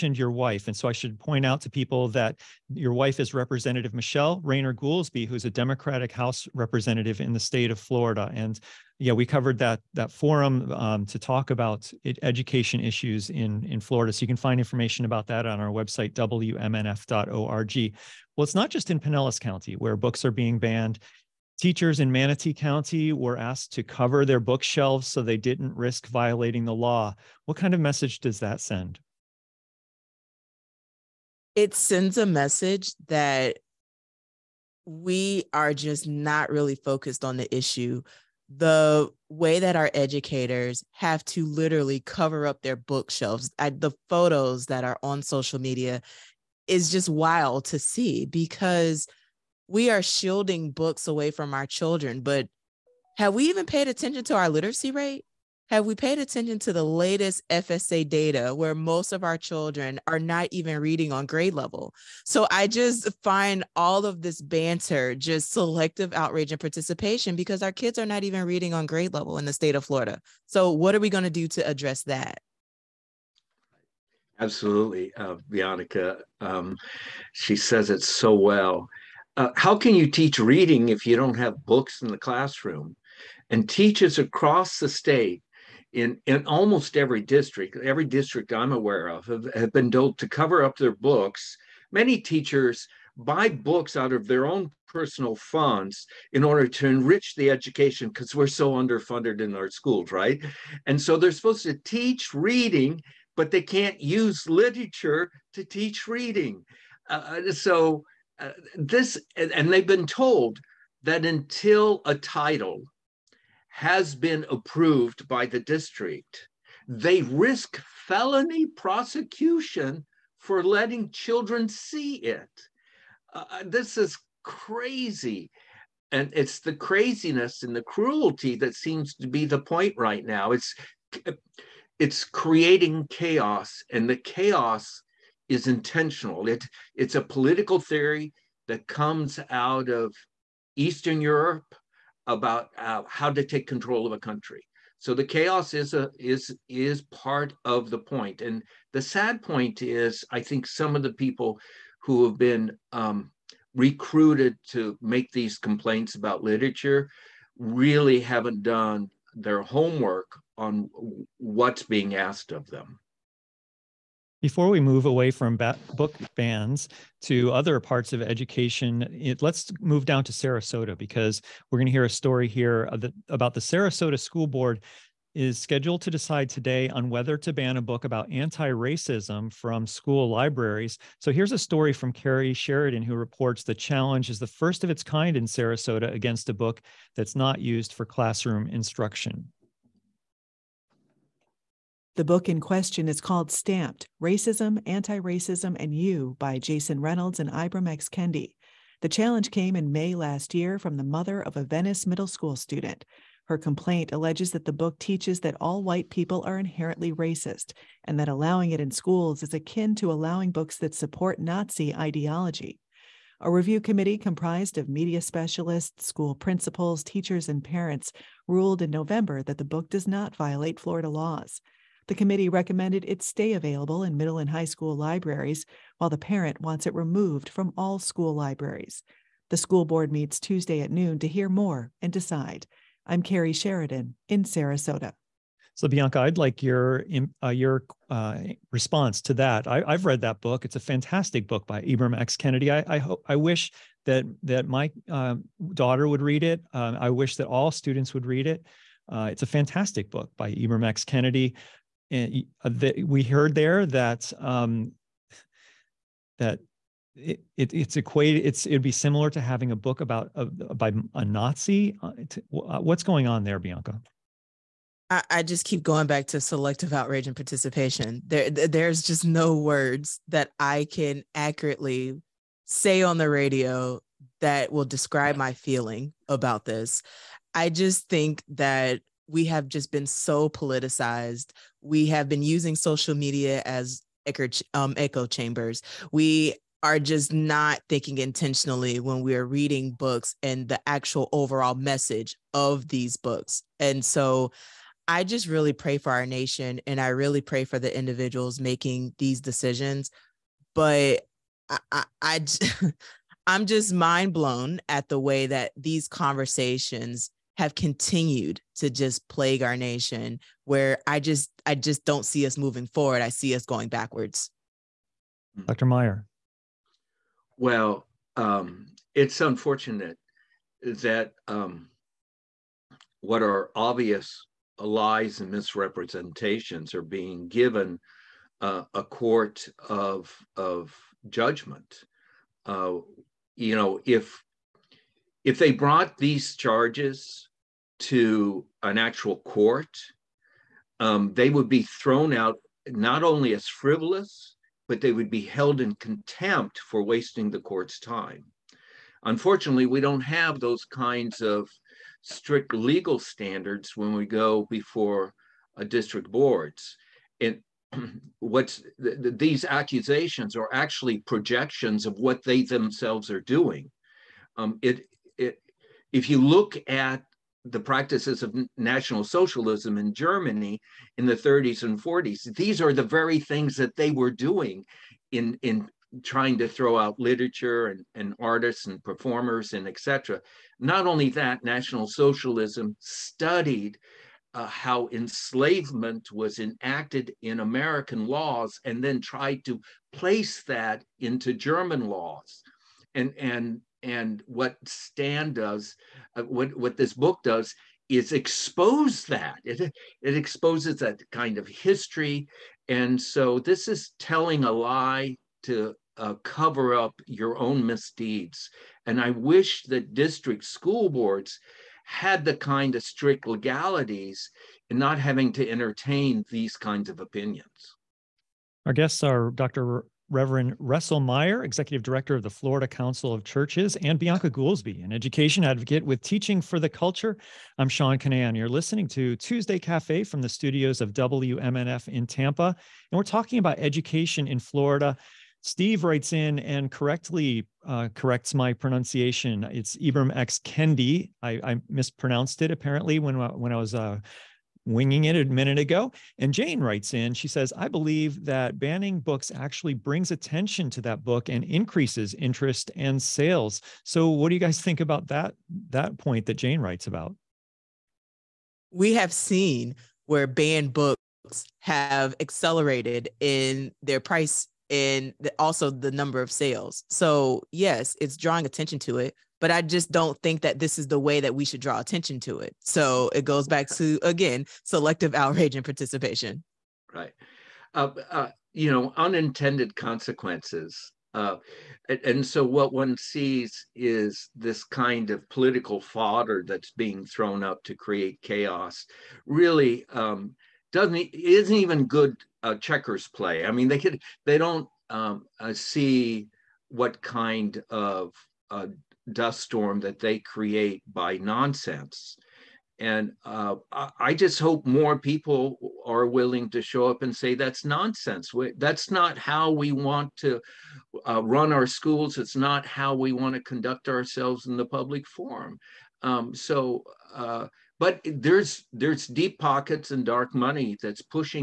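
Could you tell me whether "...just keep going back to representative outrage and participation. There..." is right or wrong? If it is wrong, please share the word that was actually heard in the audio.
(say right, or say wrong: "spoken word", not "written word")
wrong: "selective", not "representative".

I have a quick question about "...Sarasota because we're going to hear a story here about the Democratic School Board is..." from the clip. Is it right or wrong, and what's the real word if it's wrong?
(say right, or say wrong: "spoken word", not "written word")
wrong: "Sarasota", not "Democratic".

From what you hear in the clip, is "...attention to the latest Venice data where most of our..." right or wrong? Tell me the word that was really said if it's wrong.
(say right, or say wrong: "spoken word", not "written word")
wrong: "FSA", not "Venice".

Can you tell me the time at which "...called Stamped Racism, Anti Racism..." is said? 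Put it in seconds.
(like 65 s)
193 s.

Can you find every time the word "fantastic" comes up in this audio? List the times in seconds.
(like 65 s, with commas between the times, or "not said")
240 s, 249 s.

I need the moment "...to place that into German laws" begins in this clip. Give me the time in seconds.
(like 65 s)
389 s.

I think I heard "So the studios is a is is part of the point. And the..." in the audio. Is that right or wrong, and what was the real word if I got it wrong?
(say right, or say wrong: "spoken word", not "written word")
wrong: "chaos", not "studios".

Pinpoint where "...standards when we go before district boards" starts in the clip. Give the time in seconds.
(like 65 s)
353 s.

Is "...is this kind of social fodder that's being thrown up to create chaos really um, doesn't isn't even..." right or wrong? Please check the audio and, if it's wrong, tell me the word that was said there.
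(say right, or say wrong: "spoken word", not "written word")
wrong: "political", not "social".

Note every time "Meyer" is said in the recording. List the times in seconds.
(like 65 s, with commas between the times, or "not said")
315 s, 421 s.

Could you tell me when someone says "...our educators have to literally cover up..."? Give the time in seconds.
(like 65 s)
39 s.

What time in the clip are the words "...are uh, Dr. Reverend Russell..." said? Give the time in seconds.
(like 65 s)
419 s.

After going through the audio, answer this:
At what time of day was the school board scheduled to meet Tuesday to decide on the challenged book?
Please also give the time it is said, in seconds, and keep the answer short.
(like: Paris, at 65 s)
Noon, at 230 s.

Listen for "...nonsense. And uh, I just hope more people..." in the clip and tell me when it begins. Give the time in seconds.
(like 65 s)
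501 s.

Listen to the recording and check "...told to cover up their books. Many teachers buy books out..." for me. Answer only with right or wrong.
right.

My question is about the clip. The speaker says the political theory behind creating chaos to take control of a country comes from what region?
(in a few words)
Eastern Europe.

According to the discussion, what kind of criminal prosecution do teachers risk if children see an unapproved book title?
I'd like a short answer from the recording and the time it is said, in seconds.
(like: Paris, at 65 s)
Felony prosecution, at 118 s.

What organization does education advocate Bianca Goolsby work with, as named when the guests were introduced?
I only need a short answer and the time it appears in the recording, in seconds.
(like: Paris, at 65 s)
Teaching for the Culture, at 426 s.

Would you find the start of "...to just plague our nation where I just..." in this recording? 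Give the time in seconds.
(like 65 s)
308 s.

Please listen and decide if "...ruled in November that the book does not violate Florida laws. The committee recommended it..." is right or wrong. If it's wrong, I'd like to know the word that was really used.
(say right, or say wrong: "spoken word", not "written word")
right.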